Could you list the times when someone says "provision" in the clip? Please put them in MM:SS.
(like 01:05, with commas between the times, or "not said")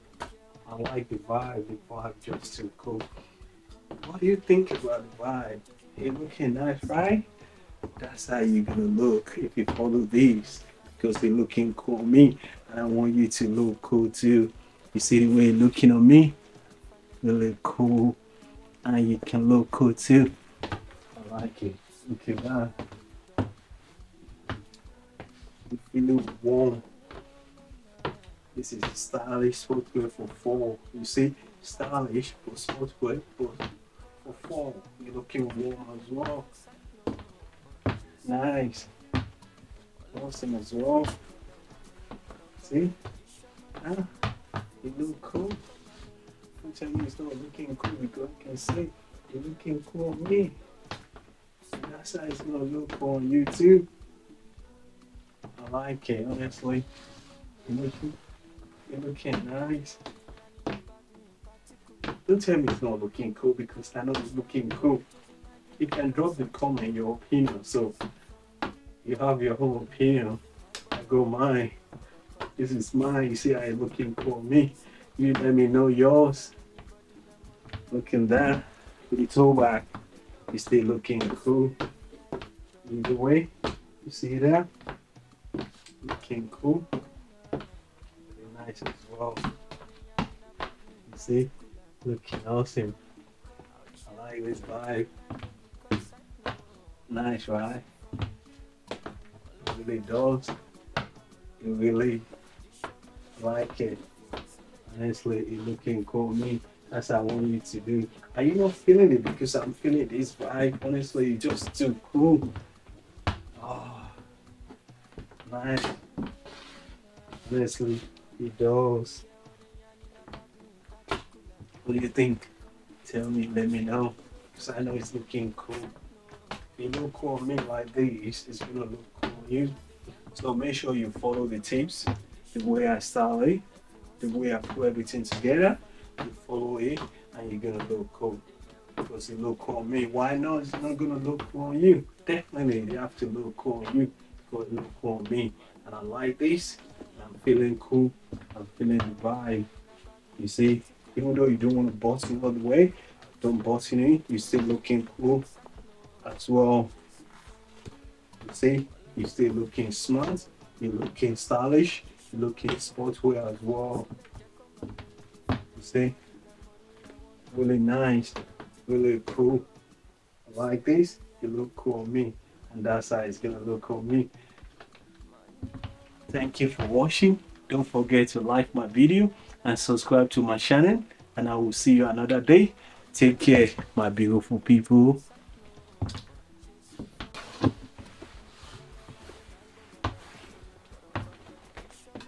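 not said.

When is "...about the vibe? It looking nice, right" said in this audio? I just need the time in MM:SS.
00:04.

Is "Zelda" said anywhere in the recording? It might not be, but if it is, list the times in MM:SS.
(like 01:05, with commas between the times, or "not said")
not said.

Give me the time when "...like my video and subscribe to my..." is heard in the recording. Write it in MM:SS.
02:58.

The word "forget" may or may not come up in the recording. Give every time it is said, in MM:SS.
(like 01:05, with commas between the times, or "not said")
02:57.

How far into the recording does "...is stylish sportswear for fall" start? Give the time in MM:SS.
00:28.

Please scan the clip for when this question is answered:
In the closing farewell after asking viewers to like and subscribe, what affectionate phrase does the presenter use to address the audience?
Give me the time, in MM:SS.
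03:03.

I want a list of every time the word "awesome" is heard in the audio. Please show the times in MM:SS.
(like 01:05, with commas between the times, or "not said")
00:40, 01:32.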